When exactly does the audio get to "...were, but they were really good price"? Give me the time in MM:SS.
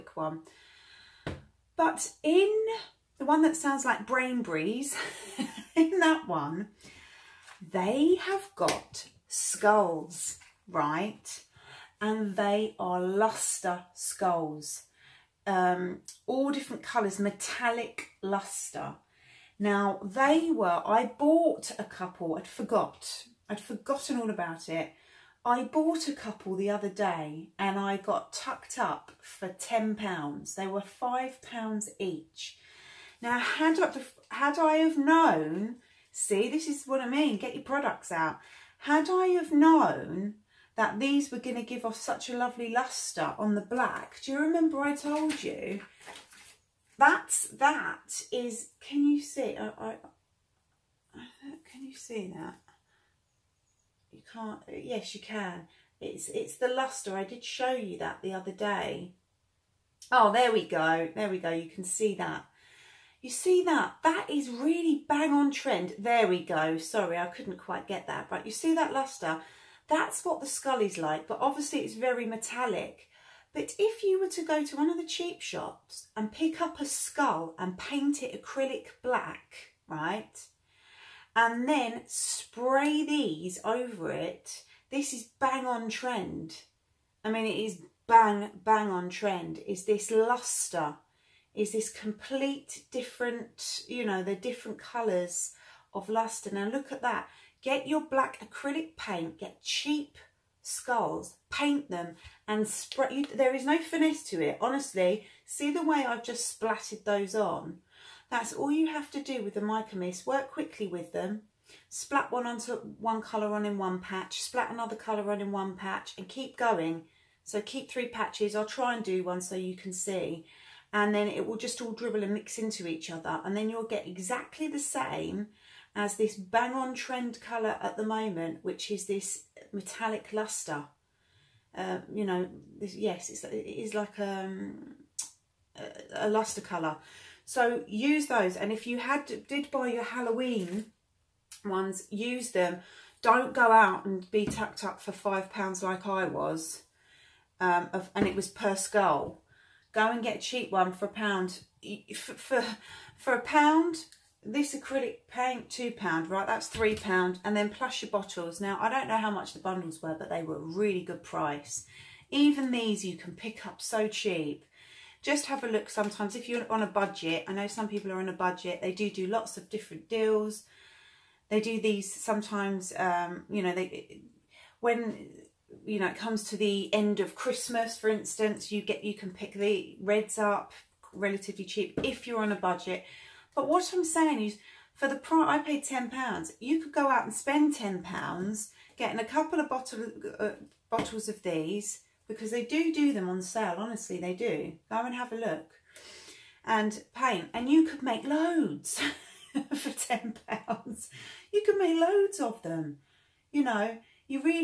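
02:40.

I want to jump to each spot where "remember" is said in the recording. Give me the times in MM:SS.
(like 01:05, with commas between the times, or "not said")
00:44.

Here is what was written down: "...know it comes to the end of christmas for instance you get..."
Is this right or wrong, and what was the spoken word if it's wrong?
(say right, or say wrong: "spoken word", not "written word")
right.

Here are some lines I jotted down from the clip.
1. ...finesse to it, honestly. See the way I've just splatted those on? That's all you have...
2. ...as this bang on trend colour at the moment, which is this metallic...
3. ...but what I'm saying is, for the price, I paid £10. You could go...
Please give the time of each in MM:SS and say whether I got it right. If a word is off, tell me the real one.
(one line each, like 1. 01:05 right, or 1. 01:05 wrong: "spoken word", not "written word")
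1. 01:43 right
2. 02:05 right
3. 03:03 right.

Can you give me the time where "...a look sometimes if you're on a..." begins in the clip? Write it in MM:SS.
02:45.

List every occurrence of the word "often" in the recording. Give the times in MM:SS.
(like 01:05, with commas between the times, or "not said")
not said.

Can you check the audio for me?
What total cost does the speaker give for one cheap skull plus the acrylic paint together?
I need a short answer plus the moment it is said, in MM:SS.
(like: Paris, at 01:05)
£3, at 02:36.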